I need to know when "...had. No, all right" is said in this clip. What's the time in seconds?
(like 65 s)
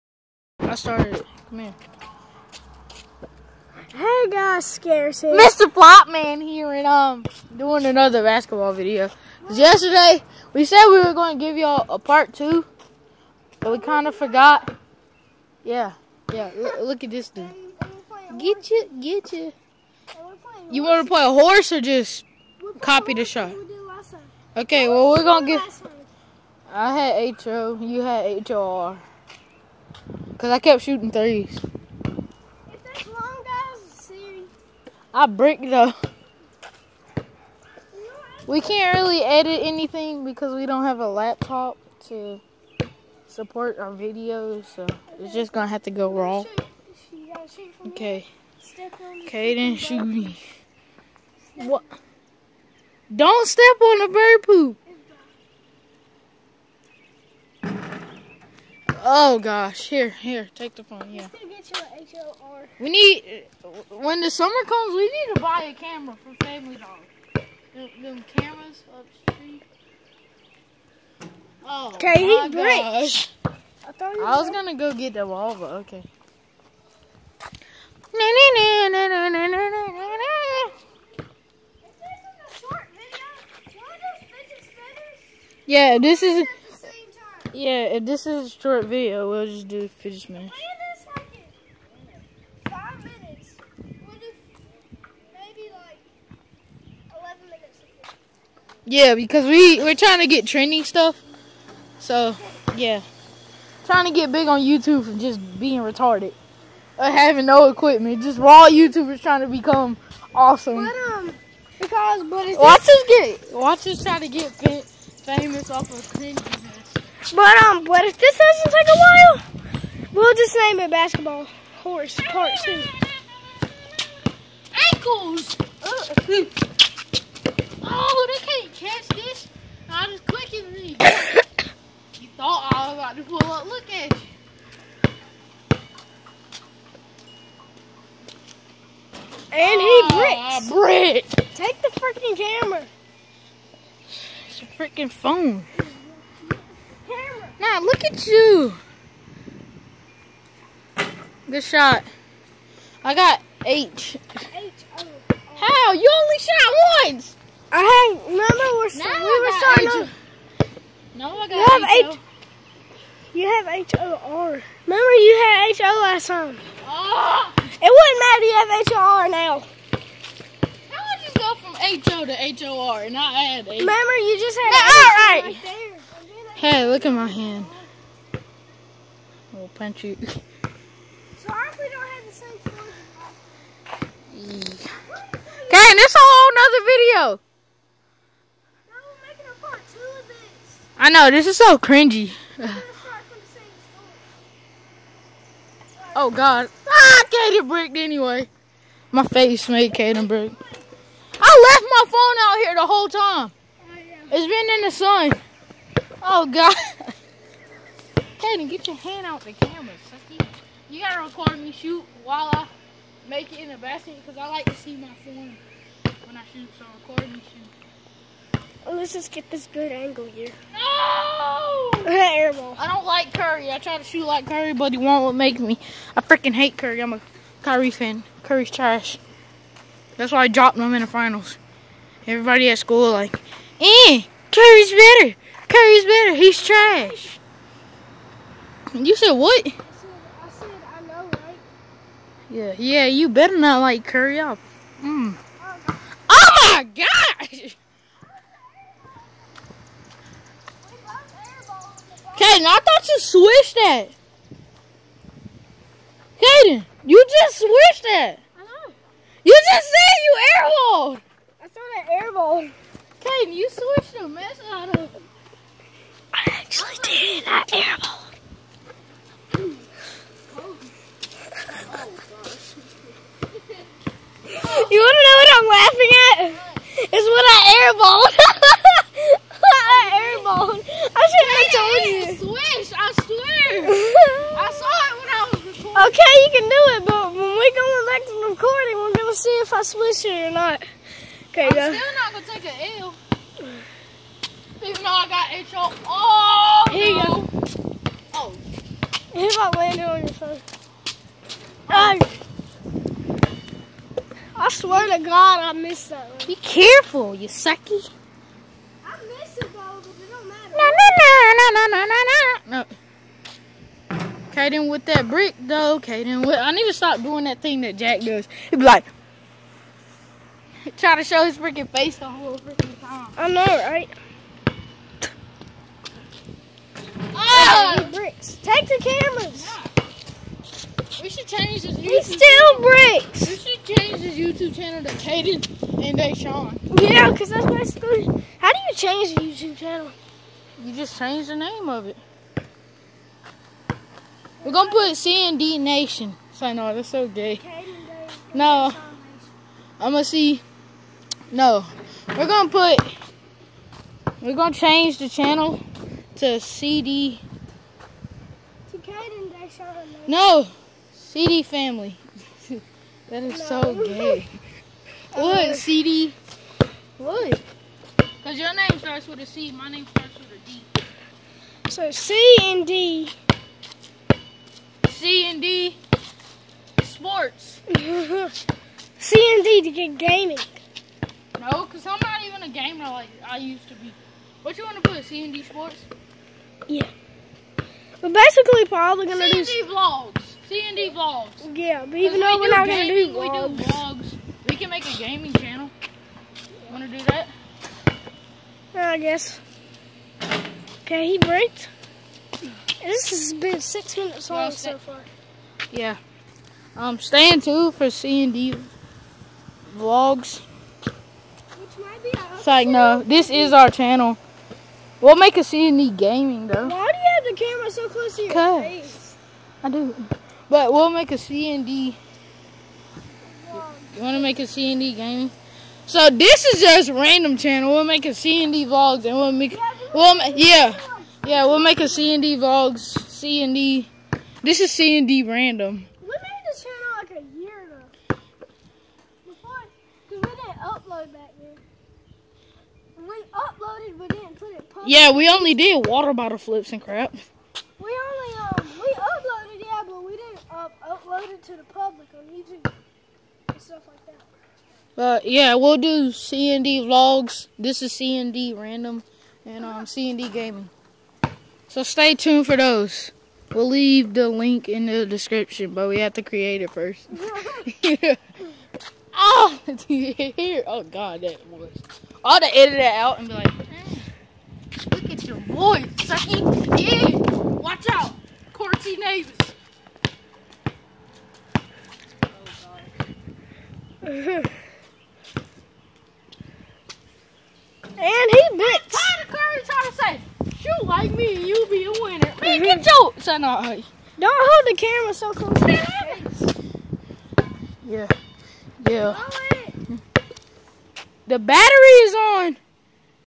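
174 s.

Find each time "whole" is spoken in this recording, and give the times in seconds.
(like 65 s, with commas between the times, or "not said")
186 s, 202 s, 322 s.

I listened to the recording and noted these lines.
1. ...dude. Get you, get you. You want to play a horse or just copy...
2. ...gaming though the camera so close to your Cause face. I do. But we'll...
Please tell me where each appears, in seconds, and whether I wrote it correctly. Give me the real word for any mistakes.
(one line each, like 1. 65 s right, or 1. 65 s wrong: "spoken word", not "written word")
1. 17 s right
2. 416 s right.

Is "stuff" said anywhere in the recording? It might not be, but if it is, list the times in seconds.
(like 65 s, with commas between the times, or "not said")
100 s, 453 s.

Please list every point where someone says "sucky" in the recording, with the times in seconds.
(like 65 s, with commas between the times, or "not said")
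210 s, 307 s, 476 s.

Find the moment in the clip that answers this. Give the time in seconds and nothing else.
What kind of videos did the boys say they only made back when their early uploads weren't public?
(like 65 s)
446 s.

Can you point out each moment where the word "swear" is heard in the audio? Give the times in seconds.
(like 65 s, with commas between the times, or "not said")
283 s, 304 s.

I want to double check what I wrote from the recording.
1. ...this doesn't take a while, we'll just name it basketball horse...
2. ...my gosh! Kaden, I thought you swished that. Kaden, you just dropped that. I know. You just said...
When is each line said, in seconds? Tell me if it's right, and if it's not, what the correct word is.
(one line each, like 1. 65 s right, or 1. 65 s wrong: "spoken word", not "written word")
1. 118 s right
2. 246 s wrong: "swished", not "dropped".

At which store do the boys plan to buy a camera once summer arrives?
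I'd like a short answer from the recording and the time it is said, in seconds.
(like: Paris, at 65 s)
Family Dollar, at 66 s.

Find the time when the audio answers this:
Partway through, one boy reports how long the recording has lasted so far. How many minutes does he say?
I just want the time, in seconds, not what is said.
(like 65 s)
403 s.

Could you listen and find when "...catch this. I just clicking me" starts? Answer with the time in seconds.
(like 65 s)
128 s.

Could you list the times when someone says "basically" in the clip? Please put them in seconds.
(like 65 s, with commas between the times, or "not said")
337 s, 388 s.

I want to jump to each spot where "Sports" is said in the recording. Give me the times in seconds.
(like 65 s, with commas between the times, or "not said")
377 s, 385 s.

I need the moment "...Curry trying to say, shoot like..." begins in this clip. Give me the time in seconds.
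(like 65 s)
489 s.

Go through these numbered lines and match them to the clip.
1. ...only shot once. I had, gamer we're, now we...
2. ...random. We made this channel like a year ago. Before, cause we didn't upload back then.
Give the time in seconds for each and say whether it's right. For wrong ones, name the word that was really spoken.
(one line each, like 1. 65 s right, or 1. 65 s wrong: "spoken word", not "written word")
1. 156 s wrong: "remember", not "gamer"
2. 435 s right.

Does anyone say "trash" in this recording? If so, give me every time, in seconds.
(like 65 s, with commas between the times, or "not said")
228 s, 236 s.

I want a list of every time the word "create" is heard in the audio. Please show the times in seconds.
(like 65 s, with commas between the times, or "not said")
466 s.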